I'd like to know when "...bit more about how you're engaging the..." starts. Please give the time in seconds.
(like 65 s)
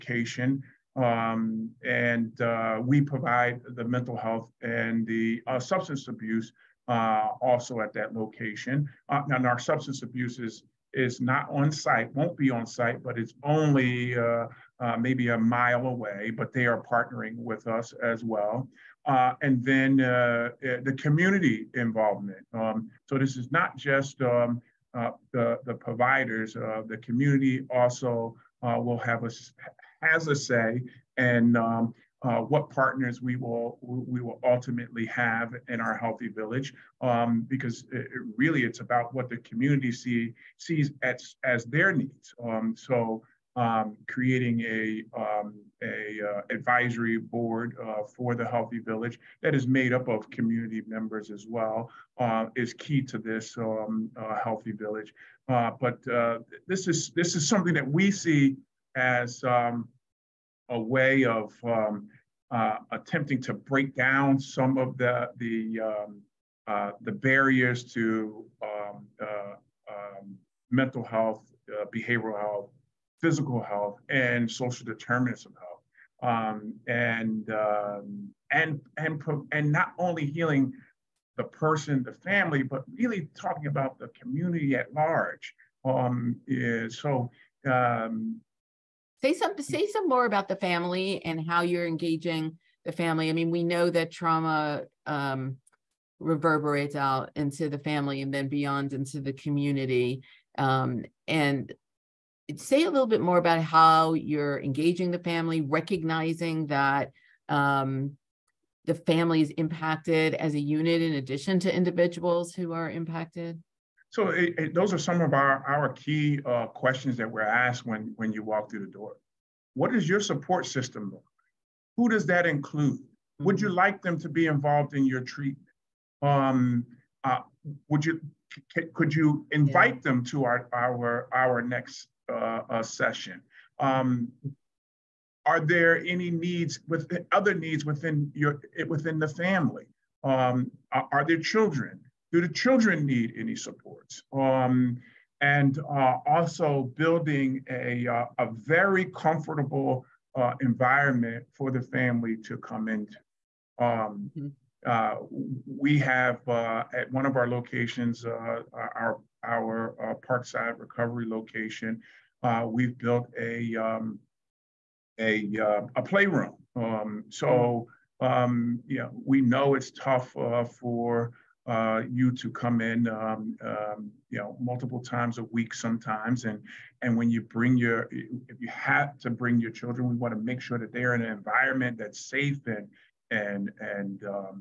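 103 s.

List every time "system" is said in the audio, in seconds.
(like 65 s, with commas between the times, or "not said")
120 s.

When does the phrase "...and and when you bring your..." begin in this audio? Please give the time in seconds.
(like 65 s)
176 s.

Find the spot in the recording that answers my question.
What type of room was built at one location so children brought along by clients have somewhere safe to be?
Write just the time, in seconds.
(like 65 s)
166 s.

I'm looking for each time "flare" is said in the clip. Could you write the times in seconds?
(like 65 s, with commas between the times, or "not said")
not said.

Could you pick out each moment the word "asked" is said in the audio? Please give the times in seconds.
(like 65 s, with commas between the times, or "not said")
117 s.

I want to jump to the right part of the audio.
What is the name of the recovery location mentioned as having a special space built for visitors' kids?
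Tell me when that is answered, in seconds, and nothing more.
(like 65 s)
160 s.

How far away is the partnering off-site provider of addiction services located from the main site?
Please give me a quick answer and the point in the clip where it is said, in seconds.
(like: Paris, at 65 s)
a mile, at 15 s.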